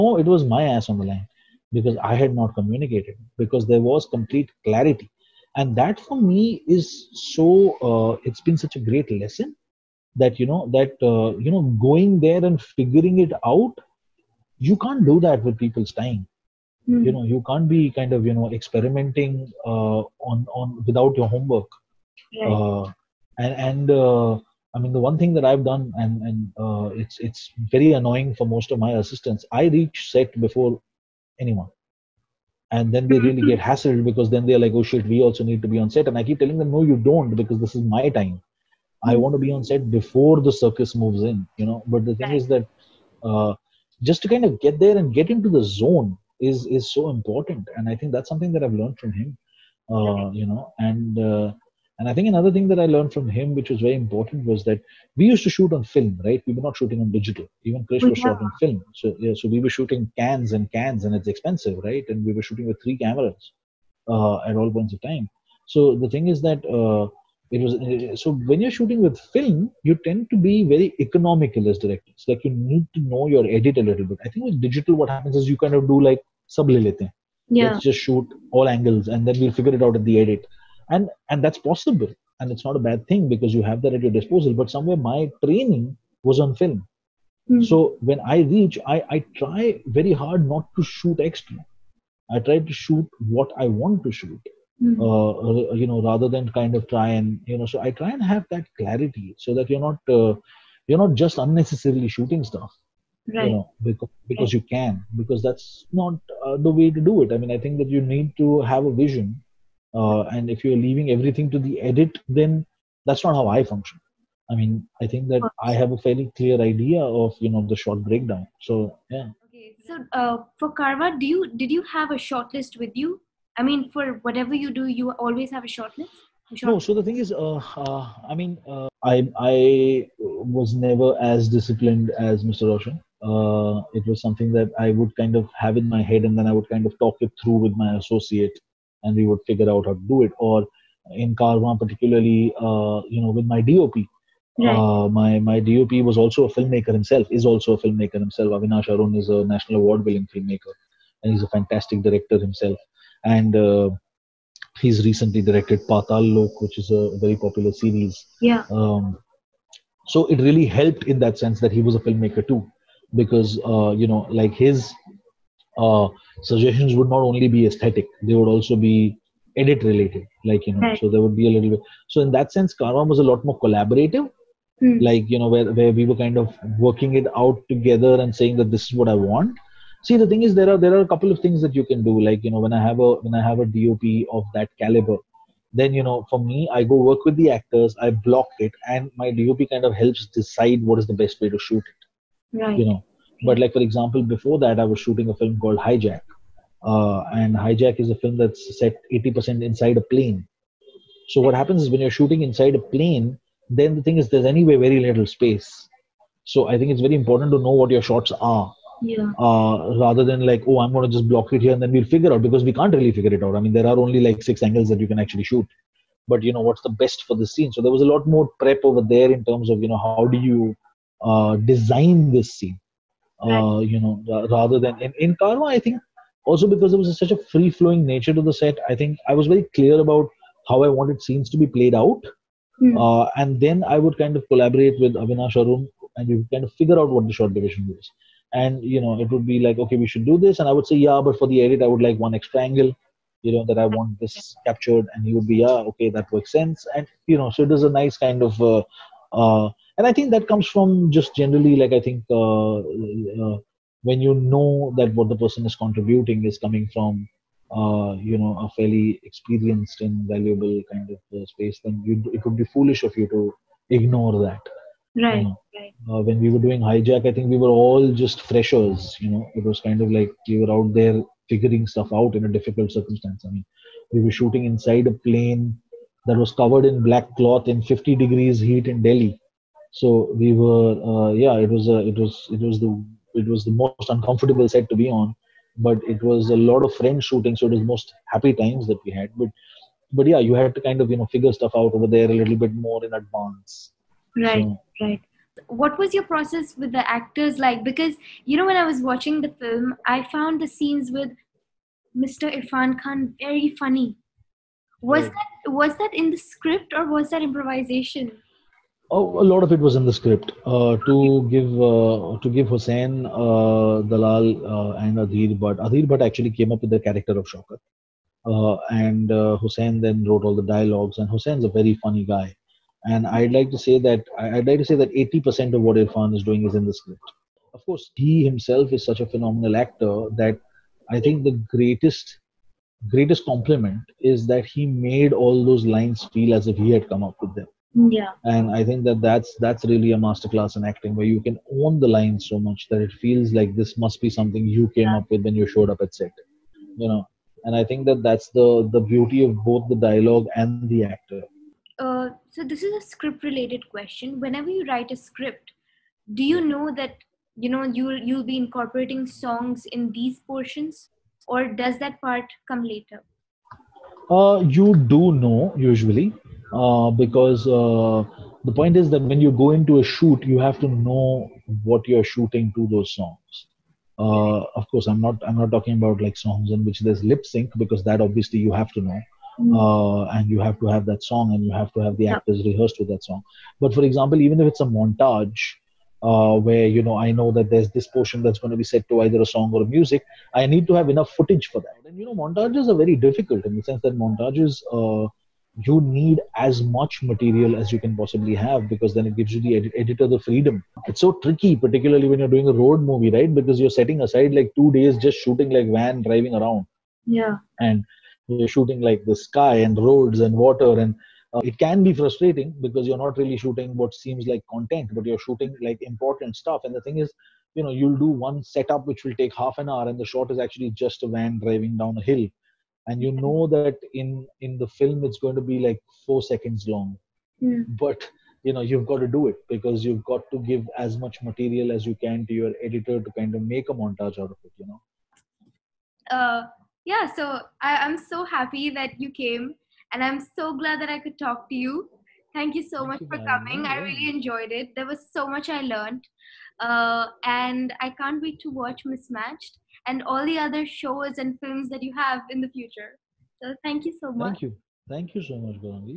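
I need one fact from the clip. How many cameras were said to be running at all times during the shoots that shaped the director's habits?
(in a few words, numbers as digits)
3.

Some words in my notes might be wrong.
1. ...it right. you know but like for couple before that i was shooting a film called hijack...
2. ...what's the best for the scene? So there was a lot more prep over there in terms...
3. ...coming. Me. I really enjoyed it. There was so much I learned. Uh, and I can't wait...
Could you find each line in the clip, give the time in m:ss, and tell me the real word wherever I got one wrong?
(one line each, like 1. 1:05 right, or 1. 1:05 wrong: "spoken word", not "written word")
1. 3:11 wrong: "example", not "couple"
2. 3:36 right
3. 7:23 right.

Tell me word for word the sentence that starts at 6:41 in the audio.
It's so tricky, particularly when you're doing a road movie, right?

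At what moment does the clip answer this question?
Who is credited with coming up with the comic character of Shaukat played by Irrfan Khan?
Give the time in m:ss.
5:15.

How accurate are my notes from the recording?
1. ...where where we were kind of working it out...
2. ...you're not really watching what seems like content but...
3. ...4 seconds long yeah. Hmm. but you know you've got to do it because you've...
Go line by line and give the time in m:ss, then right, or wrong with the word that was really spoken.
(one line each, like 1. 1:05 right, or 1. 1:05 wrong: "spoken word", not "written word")
1. 2:55 right
2. 6:53 wrong: "shooting", not "watching"
3. 7:06 right.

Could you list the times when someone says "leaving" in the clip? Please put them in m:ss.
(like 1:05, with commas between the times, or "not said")
1:50.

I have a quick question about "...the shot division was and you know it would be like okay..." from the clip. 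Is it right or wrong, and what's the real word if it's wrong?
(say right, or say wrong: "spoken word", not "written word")
right.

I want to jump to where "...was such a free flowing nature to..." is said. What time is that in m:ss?
3:46.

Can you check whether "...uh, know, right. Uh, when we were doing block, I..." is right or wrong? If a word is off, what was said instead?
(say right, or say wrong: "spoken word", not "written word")
wrong: "hijack", not "block".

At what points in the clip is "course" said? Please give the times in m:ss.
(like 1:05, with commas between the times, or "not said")
5:27, 6:14.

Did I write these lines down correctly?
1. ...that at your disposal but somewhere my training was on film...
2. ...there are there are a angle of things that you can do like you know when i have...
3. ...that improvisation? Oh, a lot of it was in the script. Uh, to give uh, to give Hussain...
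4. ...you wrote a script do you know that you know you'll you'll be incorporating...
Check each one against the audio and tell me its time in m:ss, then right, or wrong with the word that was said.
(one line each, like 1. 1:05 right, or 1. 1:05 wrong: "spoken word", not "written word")
1. 1:23 right
2. 3:00 wrong: "couple", not "angle"
3. 5:07 right
4. 5:54 wrong: "write", not "wrote".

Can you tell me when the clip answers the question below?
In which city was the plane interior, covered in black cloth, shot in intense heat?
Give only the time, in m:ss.
4:39.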